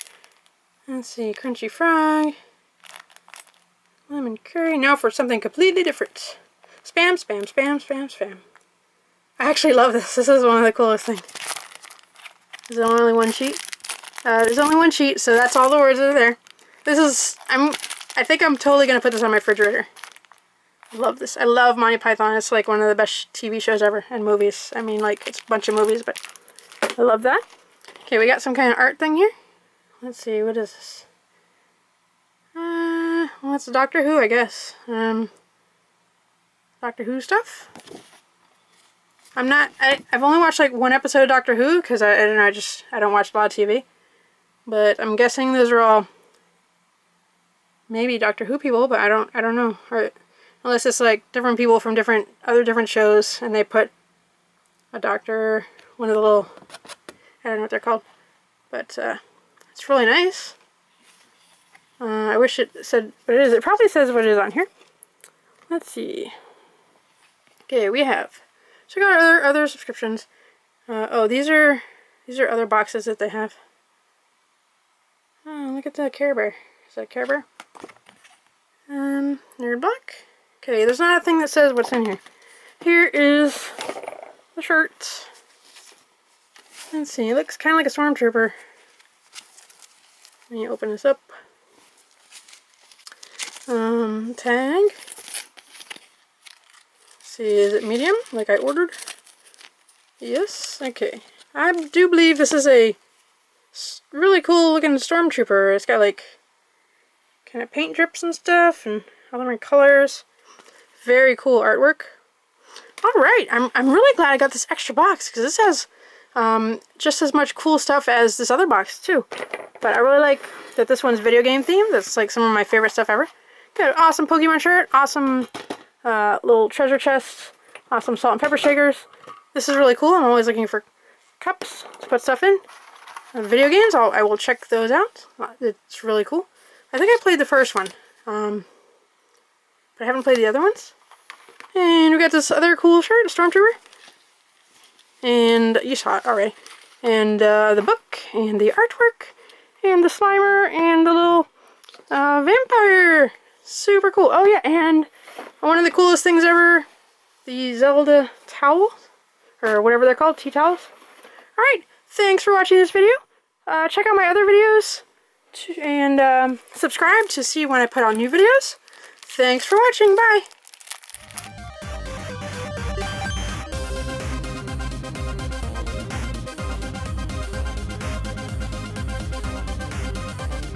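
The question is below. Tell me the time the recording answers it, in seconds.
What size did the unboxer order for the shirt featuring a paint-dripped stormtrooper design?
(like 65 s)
97 s.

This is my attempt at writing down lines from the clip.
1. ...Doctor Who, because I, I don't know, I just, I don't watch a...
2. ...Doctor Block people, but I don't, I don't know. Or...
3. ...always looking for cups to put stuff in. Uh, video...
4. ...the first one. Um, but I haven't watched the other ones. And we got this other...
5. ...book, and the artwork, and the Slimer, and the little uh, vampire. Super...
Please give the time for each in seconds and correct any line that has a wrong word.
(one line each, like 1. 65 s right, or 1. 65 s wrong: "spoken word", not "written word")
1. 41 s right
2. 48 s wrong: "Who", not "Block"
3. 130 s right
4. 137 s wrong: "played", not "watched"
5. 147 s right.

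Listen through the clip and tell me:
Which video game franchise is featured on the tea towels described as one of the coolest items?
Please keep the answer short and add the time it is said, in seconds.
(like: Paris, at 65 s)
Zelda, at 157 s.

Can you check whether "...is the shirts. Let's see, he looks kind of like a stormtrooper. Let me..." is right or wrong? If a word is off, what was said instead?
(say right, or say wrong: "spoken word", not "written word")
right.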